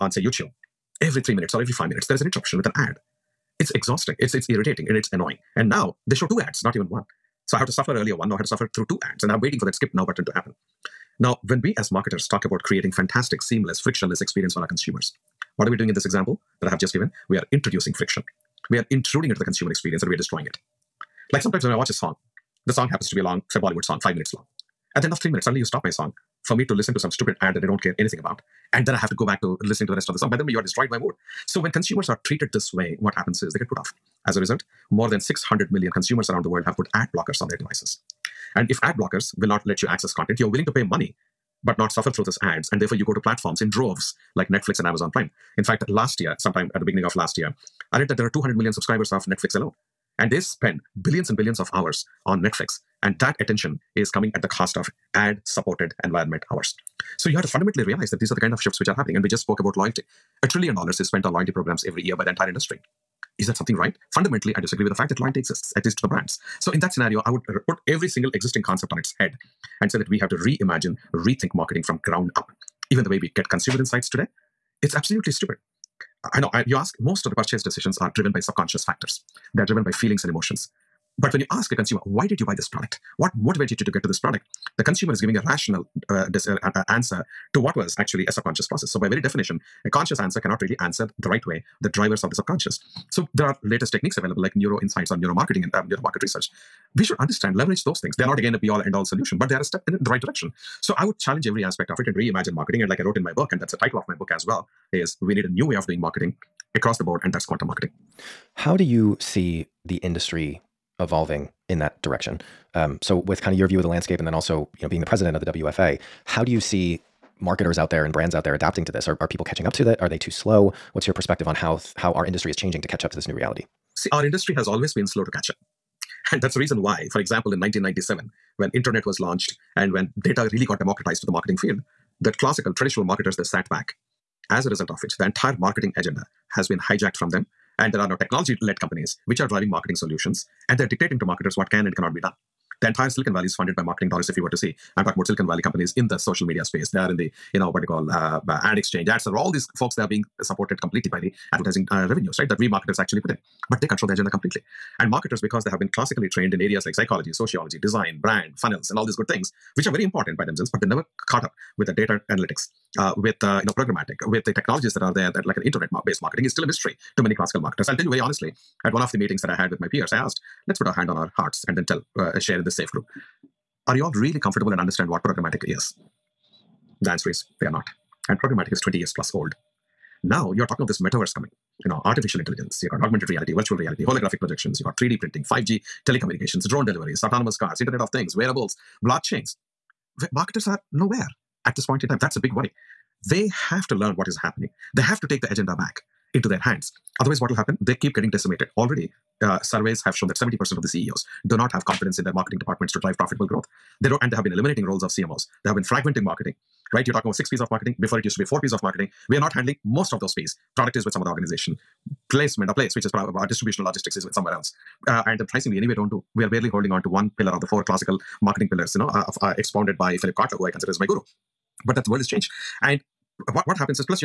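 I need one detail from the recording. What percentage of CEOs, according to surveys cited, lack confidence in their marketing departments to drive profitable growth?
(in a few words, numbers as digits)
70%.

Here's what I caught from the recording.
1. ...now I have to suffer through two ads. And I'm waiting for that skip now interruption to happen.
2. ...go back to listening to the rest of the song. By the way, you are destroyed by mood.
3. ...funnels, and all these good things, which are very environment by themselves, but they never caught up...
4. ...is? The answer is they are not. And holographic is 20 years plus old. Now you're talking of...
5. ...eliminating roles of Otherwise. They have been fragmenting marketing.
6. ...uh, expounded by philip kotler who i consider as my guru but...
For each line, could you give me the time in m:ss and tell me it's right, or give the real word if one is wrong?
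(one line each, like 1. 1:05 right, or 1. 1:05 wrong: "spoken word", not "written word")
1. 0:08 wrong: "button", not "interruption"
2. 0:29 right
3. 2:38 wrong: "important", not "environment"
4. 2:55 wrong: "programmatic", not "holographic"
5. 3:24 wrong: "CMOs", not "Otherwise"
6. 3:39 right.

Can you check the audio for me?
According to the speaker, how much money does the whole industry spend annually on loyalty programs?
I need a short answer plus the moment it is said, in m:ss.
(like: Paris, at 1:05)
A trillion dollars, at 1:00.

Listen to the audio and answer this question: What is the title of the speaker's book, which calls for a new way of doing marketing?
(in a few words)
Quantum Marketing.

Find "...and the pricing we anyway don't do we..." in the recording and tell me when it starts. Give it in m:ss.
3:35.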